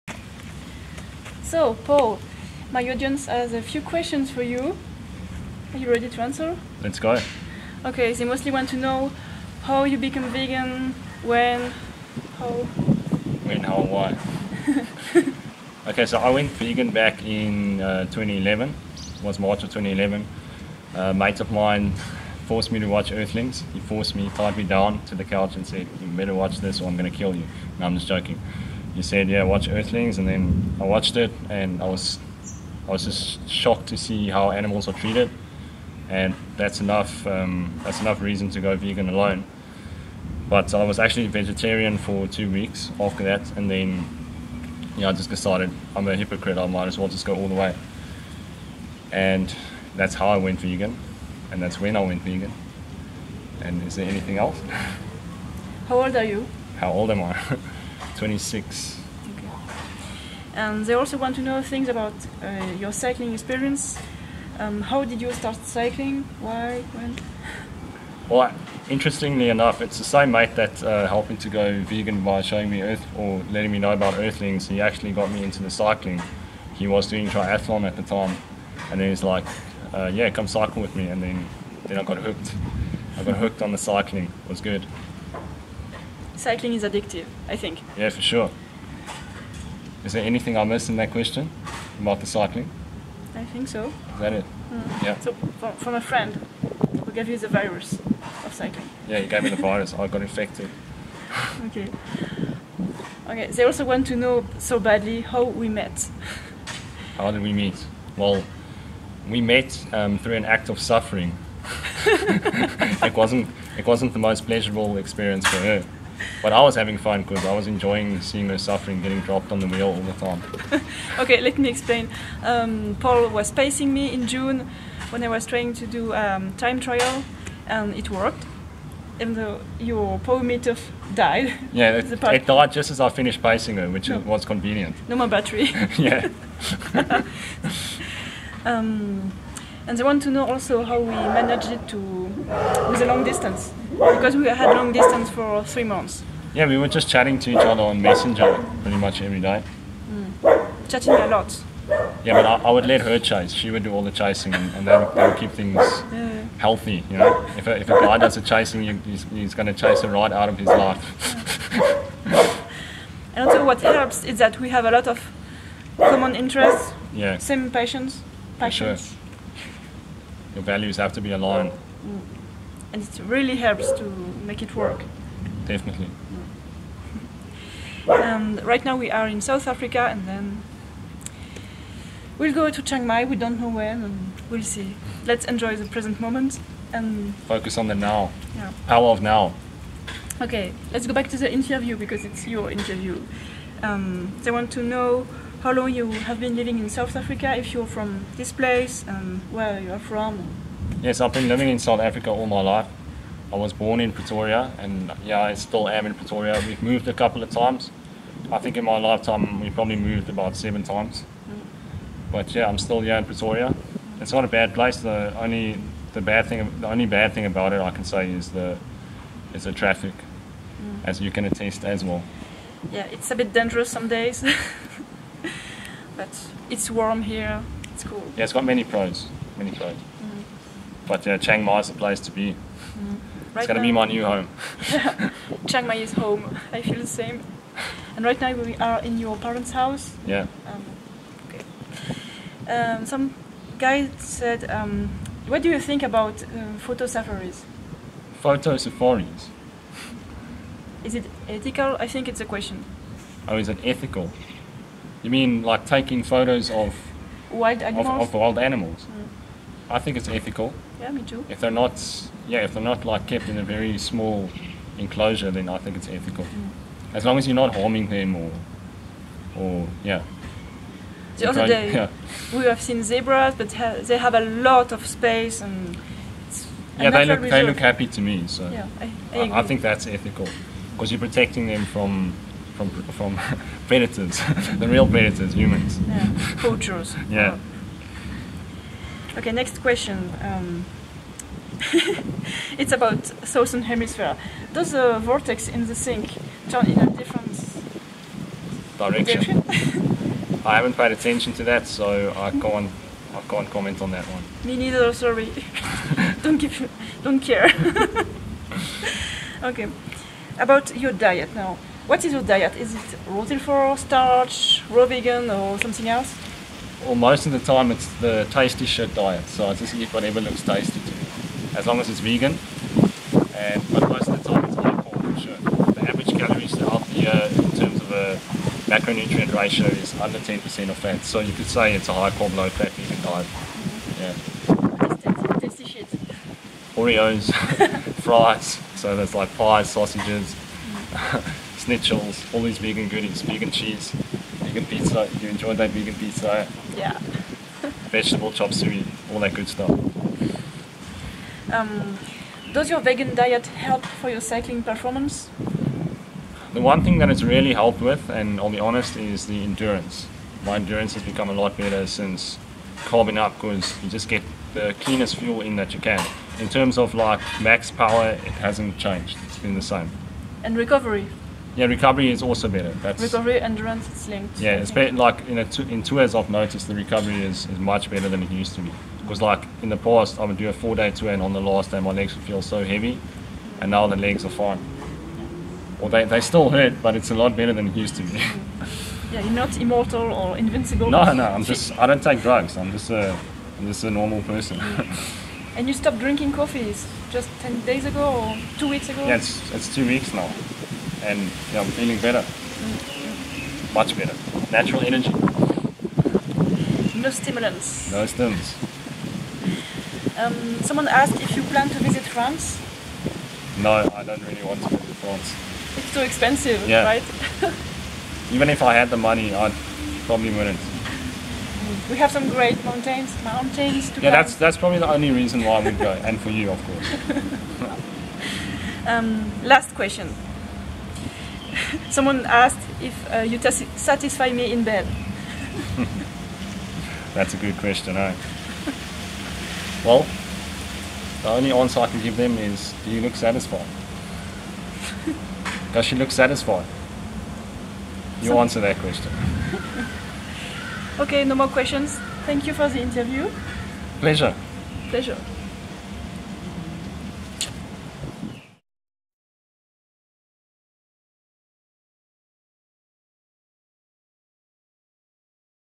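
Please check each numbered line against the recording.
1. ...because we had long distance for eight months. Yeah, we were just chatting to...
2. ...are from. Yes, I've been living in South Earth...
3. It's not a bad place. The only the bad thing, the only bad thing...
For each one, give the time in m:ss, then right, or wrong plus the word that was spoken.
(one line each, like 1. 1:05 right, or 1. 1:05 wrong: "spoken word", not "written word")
1. 2:23 wrong: "three", not "eight"
2. 3:19 wrong: "Africa", not "Earth"
3. 3:34 right.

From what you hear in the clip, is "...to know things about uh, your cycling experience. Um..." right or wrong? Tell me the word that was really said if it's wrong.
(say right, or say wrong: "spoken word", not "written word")
right.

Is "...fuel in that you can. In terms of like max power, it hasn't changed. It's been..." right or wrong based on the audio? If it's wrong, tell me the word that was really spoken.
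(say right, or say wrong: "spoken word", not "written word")
right.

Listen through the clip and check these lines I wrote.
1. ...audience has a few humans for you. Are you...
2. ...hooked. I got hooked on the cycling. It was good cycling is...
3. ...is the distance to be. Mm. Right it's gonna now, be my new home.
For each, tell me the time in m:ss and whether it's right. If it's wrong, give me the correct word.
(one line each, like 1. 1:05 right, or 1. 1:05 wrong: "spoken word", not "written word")
1. 0:02 wrong: "questions", not "humans"
2. 1:22 right
3. 3:51 wrong: "place", not "distance".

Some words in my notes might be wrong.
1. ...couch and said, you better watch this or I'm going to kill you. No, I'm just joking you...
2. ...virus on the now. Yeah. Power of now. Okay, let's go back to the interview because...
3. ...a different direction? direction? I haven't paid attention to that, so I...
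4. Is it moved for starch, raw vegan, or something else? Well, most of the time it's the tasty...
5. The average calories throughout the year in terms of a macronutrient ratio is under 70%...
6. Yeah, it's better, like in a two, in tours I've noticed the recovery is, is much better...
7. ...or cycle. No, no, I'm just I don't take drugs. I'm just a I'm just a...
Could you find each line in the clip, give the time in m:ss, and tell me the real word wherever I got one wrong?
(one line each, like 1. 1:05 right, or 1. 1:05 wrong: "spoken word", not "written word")
1. 0:25 right
2. 3:07 wrong: "focus", not "virus"
3. 4:56 right
4. 5:12 wrong: "rooted", not "moved"
5. 5:25 wrong: "10", not "70"
6. 6:14 right
7. 6:30 wrong: "invincible", not "cycle".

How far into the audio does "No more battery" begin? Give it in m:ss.
2:15.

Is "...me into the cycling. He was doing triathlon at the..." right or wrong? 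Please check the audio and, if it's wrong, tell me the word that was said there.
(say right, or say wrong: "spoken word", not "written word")
right.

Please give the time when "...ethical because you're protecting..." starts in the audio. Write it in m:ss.
4:40.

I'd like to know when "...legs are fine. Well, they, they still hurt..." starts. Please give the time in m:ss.
6:24.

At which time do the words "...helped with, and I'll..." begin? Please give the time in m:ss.
5:57.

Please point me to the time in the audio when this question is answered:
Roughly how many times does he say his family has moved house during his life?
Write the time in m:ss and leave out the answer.
3:30.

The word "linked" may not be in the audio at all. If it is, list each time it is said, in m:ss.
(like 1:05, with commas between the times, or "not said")
6:14.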